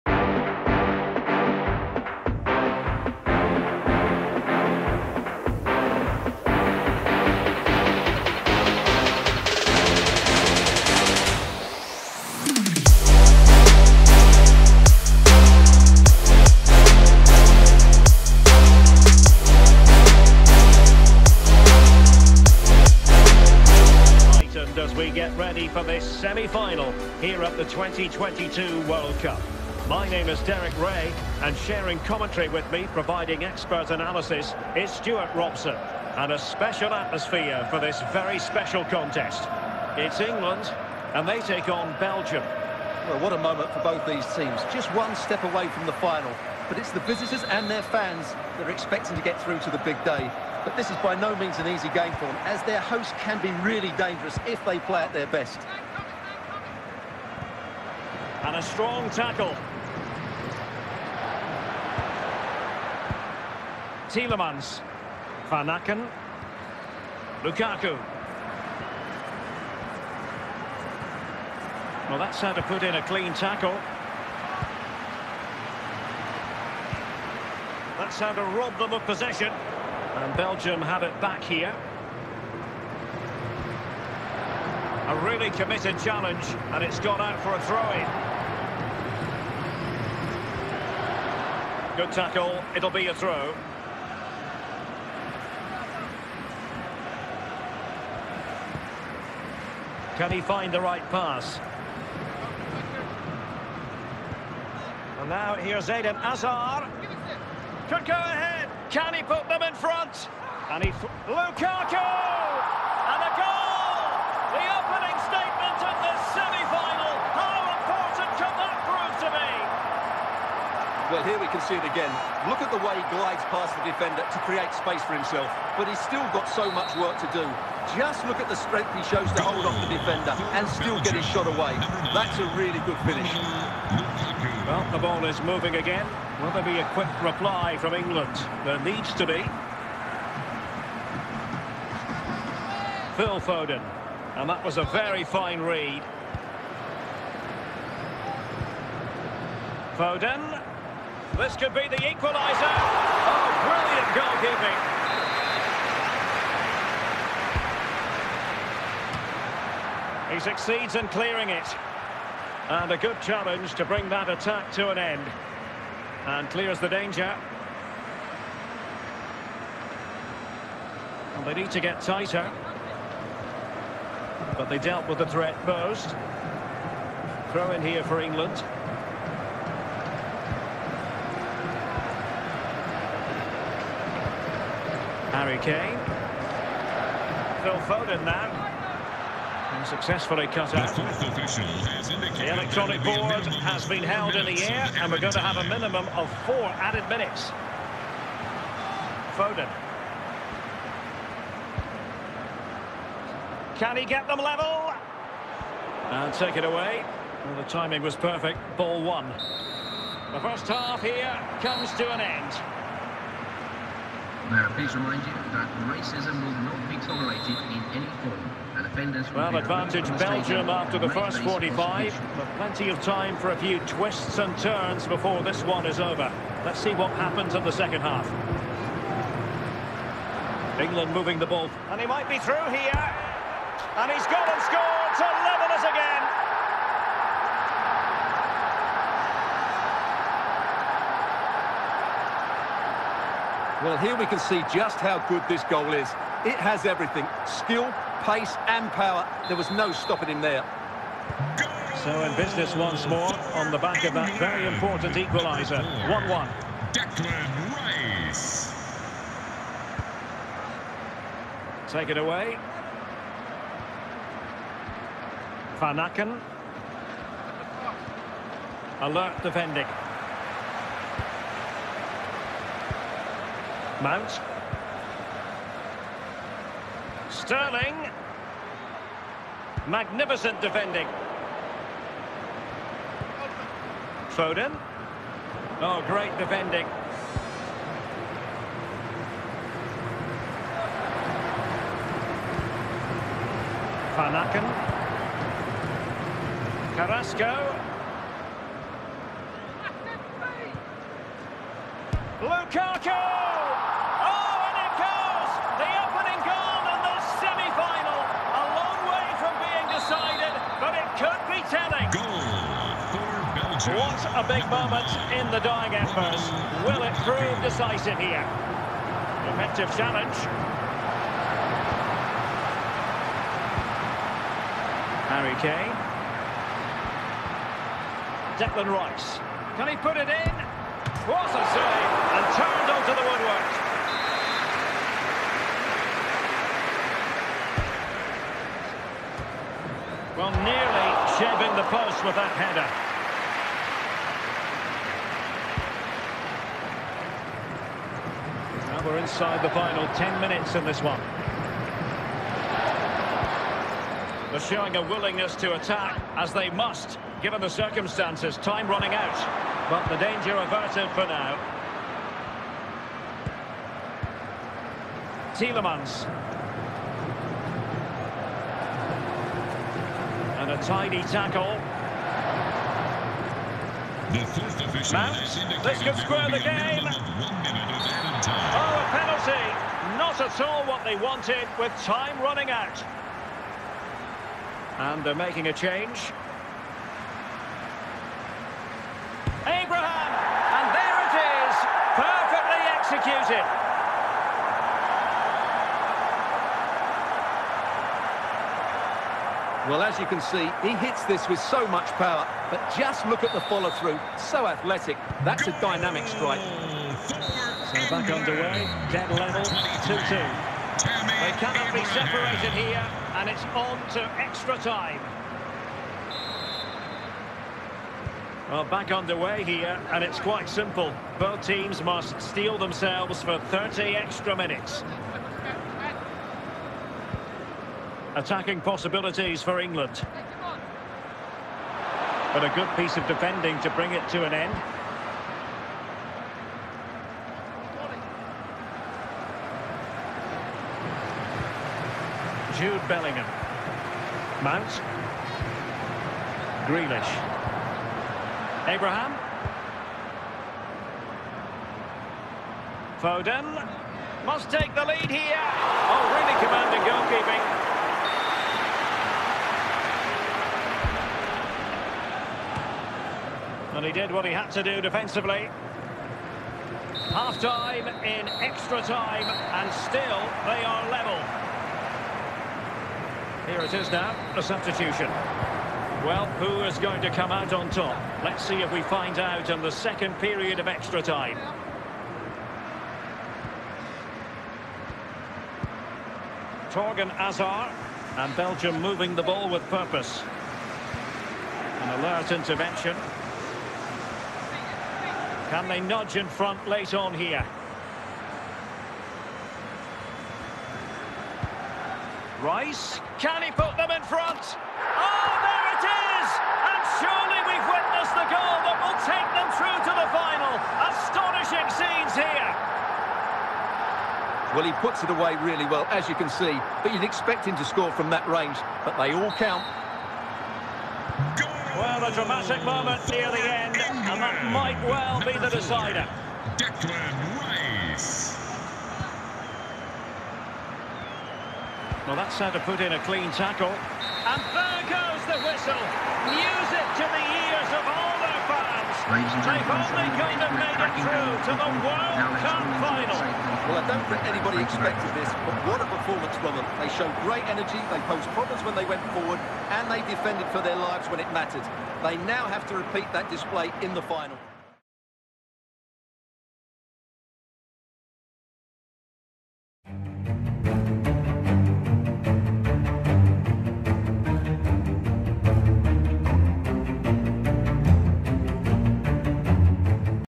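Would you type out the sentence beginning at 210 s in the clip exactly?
The first half here comes to an end.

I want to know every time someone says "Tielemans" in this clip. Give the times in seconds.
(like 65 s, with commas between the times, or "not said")
64 s, 365 s.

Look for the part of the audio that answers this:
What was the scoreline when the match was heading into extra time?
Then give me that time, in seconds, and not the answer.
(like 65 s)
409 s.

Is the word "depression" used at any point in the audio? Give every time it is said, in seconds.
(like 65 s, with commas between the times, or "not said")
not said.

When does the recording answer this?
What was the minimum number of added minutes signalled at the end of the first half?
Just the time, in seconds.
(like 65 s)
196 s.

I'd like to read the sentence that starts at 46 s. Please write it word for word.
But it's the visitors and their fans that are expecting to get through to the big day.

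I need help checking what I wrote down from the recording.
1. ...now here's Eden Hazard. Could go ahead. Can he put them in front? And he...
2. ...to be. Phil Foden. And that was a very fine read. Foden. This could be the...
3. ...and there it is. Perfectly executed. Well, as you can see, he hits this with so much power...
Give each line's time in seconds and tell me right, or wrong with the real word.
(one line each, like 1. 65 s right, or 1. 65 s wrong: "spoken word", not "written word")
1. 105 s right
2. 139 s right
3. 390 s right.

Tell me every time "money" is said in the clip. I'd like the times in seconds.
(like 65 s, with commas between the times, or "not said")
not said.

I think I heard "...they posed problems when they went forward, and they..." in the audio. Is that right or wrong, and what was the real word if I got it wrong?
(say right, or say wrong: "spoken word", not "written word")
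right.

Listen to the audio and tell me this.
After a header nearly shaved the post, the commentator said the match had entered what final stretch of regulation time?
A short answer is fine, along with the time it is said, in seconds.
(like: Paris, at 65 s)
final 10 minutes, at 349 s.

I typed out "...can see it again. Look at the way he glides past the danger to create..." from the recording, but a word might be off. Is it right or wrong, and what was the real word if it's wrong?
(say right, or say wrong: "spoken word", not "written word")
wrong: "defender", not "danger".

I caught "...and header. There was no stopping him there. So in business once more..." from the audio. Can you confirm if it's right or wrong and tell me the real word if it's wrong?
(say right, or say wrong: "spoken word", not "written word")
wrong: "power", not "header".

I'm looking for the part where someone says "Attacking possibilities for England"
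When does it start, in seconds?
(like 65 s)
428 s.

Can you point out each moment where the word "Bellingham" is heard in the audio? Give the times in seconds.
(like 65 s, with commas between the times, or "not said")
443 s.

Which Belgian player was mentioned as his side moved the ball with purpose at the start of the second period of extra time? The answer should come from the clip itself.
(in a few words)
Thorgan Hazard.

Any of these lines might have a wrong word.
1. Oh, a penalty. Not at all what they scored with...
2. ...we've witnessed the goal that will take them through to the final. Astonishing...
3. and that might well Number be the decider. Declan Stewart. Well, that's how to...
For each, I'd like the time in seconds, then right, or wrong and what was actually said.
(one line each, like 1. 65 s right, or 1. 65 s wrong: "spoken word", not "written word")
1. 377 s wrong: "wanted", not "scored"
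2. 507 s right
3. 524 s wrong: "Rice", not "Stewart".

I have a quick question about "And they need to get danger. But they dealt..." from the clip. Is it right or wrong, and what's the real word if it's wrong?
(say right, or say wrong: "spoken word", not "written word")
wrong: "tighter", not "danger".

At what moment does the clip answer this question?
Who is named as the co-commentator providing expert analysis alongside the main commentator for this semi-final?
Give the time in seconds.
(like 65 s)
34 s.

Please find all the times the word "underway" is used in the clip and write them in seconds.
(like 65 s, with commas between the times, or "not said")
408 s, 419 s.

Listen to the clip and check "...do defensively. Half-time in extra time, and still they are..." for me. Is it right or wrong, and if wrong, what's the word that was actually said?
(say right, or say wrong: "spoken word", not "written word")
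right.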